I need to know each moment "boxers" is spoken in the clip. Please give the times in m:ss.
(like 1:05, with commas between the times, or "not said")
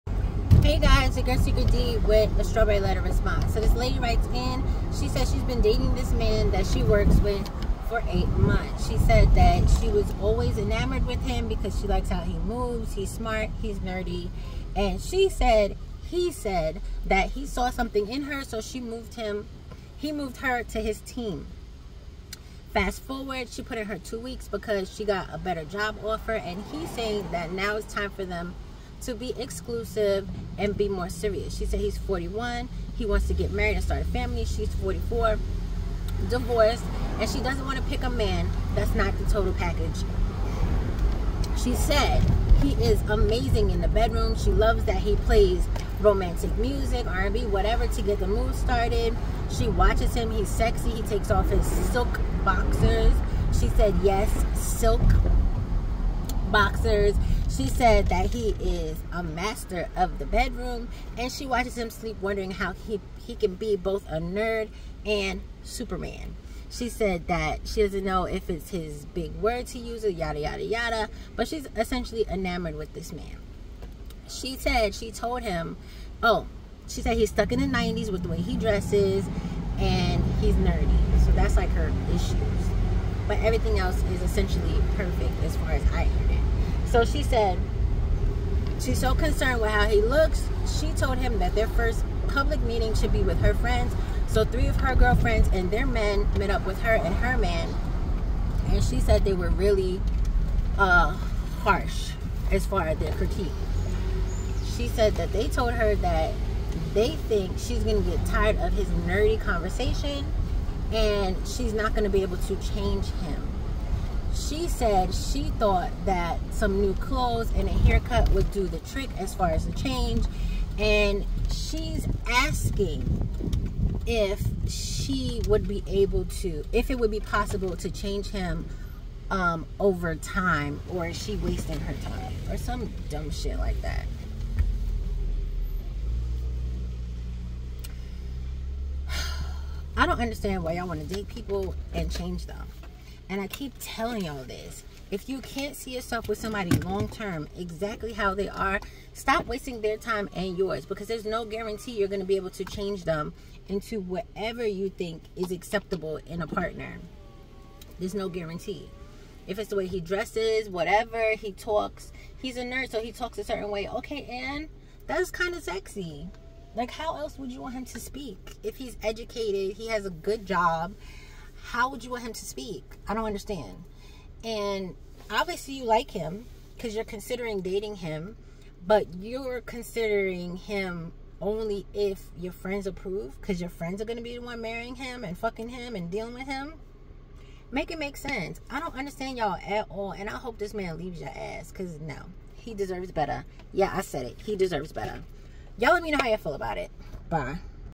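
0:52, 0:56.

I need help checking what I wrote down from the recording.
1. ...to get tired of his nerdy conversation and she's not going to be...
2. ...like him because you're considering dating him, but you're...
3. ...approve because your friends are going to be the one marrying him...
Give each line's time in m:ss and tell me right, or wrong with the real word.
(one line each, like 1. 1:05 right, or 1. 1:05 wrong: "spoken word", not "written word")
1. 1:48 right
2. 2:55 right
3. 3:02 right.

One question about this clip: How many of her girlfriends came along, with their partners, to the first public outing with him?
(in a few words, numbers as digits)
3.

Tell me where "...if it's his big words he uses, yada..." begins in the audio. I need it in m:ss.
1:08.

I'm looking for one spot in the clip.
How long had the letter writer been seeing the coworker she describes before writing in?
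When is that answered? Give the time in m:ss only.
0:08.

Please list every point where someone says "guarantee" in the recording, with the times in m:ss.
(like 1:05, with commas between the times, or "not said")
2:31, 2:38.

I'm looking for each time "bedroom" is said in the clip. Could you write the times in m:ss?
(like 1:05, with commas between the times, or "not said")
0:43, 1:00.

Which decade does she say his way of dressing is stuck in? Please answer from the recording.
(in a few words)
The 90s.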